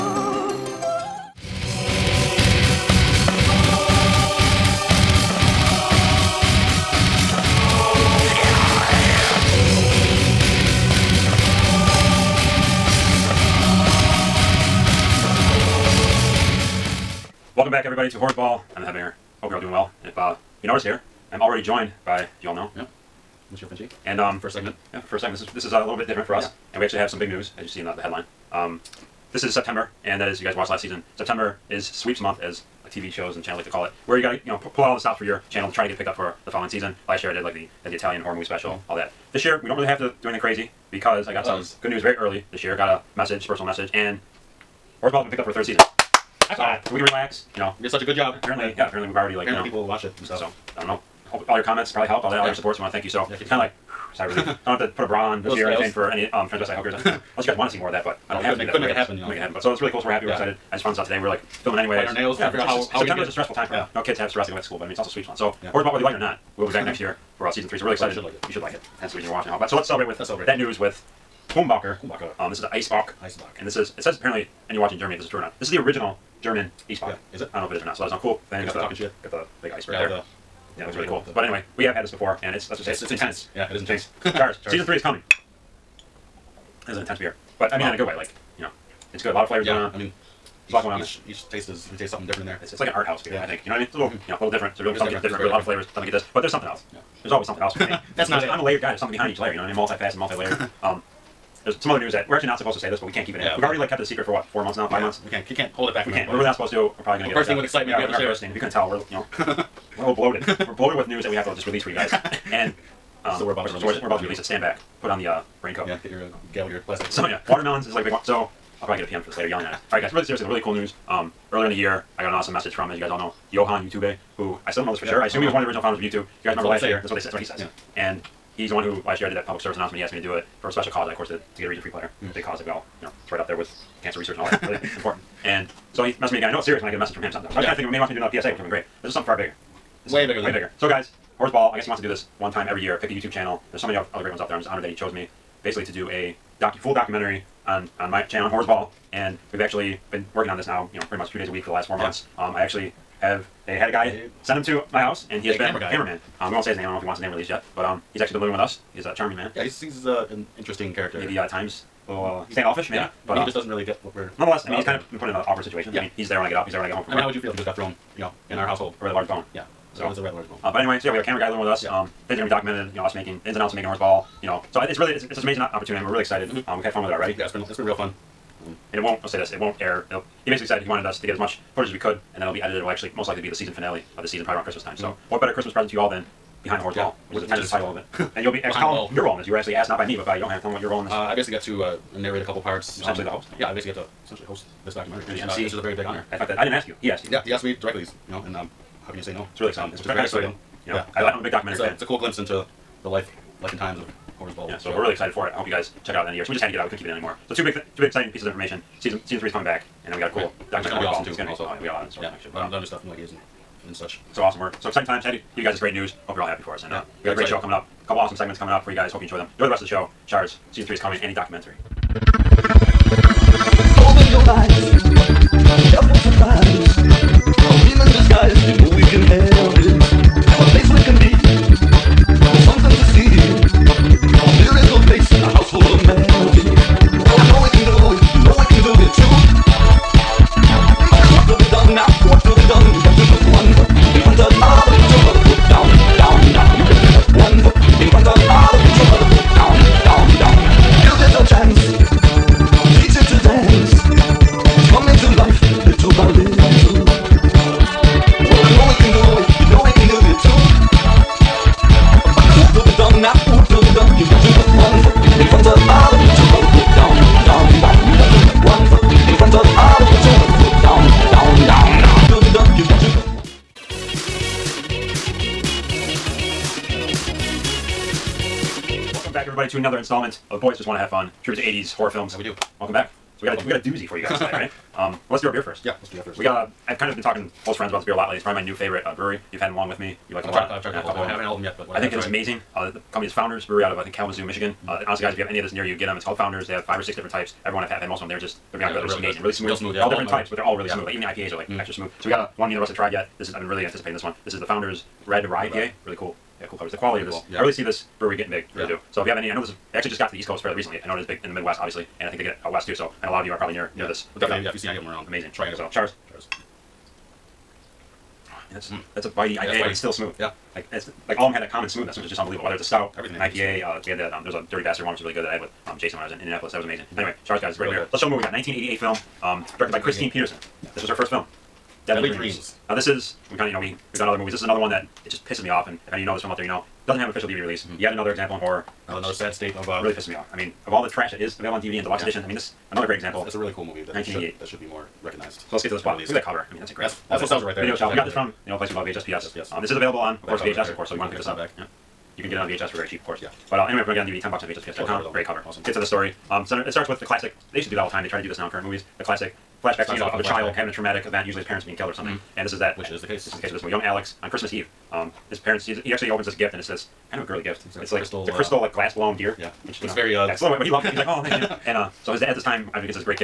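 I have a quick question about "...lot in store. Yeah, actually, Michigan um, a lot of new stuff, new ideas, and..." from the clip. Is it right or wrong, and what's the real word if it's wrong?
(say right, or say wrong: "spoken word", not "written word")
wrong: "But", not "Michigan".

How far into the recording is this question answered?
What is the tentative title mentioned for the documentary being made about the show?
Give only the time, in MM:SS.
03:06.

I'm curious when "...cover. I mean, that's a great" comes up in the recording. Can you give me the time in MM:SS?
05:46.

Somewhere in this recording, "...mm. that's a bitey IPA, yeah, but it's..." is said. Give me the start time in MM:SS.
05:18.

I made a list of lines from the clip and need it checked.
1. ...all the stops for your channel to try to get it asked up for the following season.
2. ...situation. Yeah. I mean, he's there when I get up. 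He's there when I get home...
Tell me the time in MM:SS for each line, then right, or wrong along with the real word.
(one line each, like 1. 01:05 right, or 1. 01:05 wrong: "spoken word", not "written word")
1. 00:34 wrong: "picked", not "asked"
2. 02:45 right.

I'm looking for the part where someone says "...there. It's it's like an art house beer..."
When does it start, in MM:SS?
01:32.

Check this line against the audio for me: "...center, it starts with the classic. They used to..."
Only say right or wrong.
right.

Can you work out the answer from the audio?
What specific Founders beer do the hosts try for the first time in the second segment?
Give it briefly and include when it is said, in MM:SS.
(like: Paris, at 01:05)
Red Rye IPA, at 05:05.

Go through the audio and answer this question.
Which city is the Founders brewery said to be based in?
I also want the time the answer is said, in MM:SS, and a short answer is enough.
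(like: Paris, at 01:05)
Kalamazoo, Michigan, at 04:54.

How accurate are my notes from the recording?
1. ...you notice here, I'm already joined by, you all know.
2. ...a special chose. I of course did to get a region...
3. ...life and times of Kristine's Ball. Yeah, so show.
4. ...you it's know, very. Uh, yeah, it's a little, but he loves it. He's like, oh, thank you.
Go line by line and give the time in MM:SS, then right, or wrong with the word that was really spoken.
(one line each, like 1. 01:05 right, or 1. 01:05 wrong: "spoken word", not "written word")
1. 00:20 right
2. 02:10 wrong: "cause", not "chose"
3. 03:23 wrong: "Horror", not "Kristine"
4. 06:10 right.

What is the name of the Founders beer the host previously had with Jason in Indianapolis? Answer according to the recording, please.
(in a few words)
Dirty Bastard.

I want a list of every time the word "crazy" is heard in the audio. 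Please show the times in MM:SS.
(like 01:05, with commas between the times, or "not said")
00:40.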